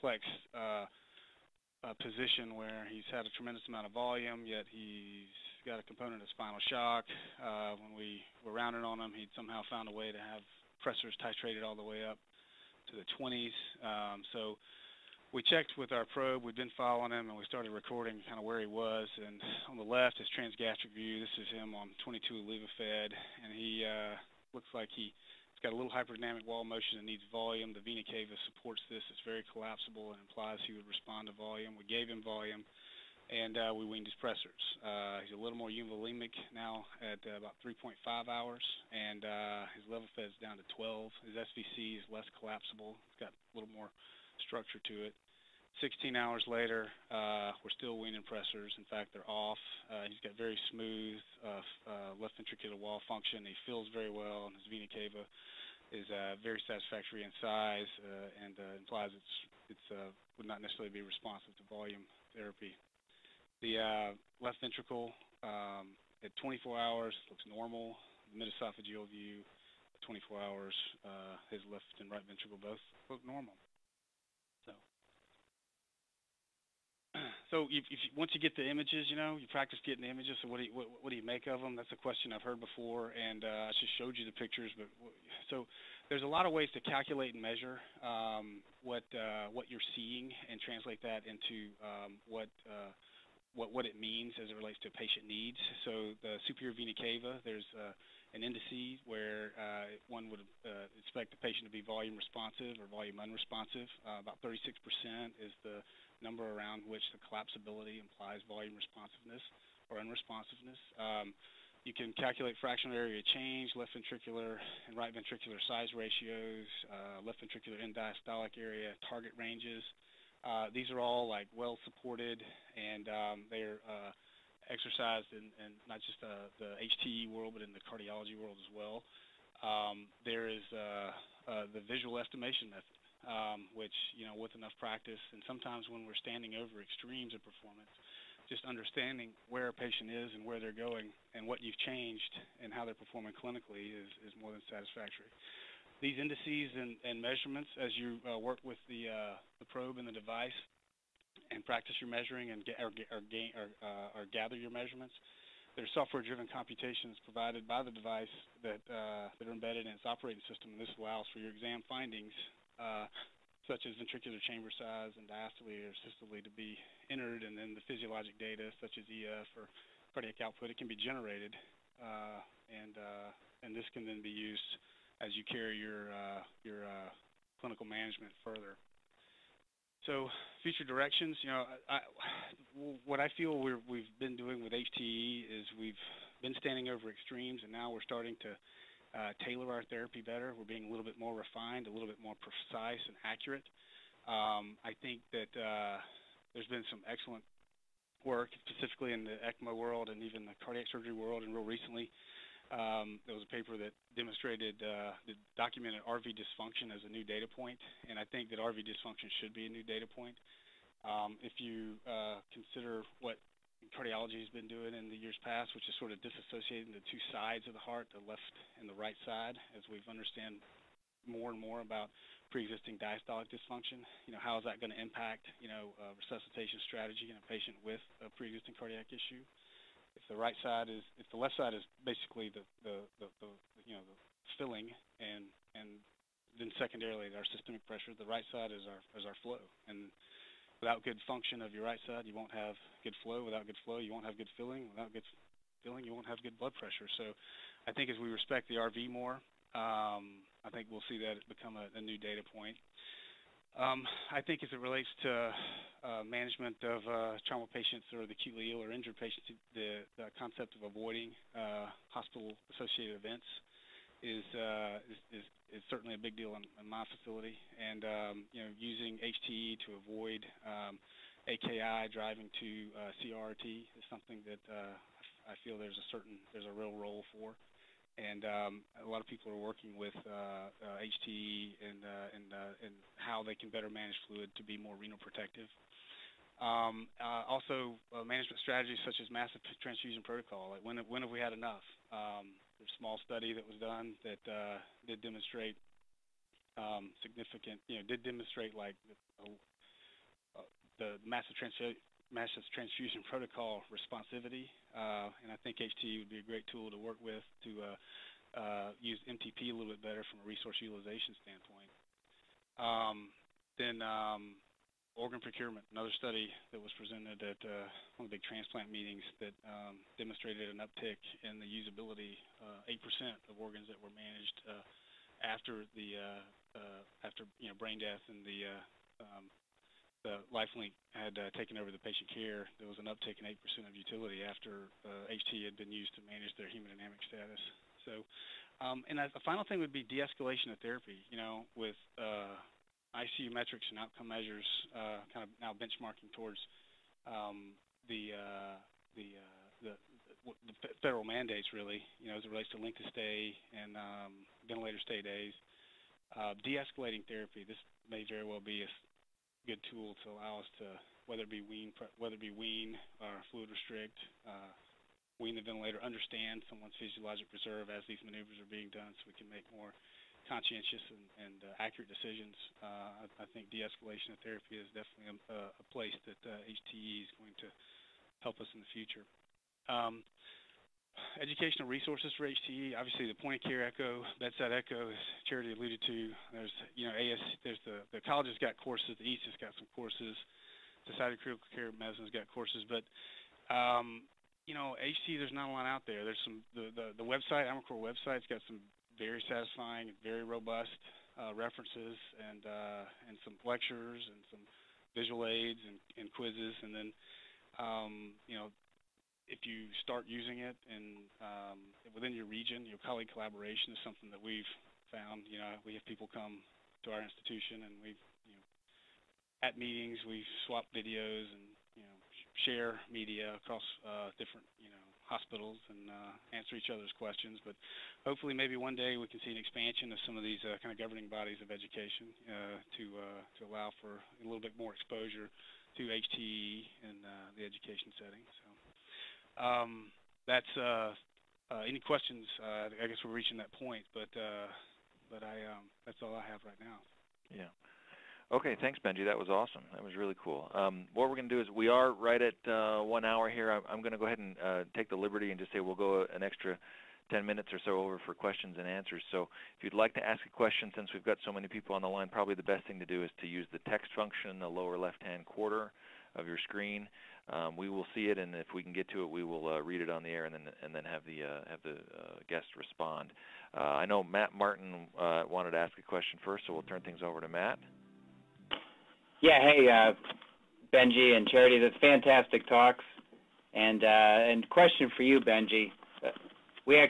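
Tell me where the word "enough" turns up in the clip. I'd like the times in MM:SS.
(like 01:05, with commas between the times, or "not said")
02:14, 04:51.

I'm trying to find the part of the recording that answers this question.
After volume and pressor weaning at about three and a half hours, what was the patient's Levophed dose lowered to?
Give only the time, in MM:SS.
00:40.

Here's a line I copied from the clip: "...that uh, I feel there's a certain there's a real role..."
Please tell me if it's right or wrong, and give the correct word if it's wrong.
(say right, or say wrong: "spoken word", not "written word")
right.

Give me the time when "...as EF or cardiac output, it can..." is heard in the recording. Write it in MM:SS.
02:48.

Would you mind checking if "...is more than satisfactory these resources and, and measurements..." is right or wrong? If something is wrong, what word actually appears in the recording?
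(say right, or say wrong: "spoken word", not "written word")
wrong: "indices", not "resources".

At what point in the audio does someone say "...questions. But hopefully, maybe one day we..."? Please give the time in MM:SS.
07:07.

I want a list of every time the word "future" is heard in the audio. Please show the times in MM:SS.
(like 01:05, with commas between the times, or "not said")
03:00, 06:18.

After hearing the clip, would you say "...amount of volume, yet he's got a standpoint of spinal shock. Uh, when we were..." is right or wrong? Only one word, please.
wrong.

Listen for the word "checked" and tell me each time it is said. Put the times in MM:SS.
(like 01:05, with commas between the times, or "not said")
00:15.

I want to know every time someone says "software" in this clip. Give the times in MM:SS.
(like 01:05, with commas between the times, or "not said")
02:35.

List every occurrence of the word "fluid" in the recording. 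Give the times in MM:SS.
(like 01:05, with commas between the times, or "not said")
04:44, 06:03.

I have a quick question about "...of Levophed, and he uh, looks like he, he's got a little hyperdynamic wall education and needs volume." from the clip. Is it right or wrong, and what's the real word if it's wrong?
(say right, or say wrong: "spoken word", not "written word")
wrong: "motion", not "education".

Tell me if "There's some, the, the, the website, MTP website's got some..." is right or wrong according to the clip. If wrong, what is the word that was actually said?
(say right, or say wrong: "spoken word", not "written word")
wrong: "ImaCor", not "MTP".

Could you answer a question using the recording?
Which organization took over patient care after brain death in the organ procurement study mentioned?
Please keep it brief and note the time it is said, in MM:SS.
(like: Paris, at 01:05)
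Lifelink, at 05:30.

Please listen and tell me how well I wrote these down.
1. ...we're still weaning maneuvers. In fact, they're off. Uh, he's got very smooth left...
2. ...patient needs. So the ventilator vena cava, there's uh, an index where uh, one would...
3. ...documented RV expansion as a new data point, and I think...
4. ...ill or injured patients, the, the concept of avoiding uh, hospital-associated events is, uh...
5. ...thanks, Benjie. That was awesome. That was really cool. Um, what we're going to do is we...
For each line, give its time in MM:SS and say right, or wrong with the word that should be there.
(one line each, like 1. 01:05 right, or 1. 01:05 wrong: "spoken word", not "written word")
1. 00:47 wrong: "pressors", not "maneuvers"
2. 01:34 wrong: "superior", not "ventilator"
3. 03:25 wrong: "dysfunction", not "expansion"
4. 04:18 right
5. 07:28 right.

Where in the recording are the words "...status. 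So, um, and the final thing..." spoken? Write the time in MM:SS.
05:37.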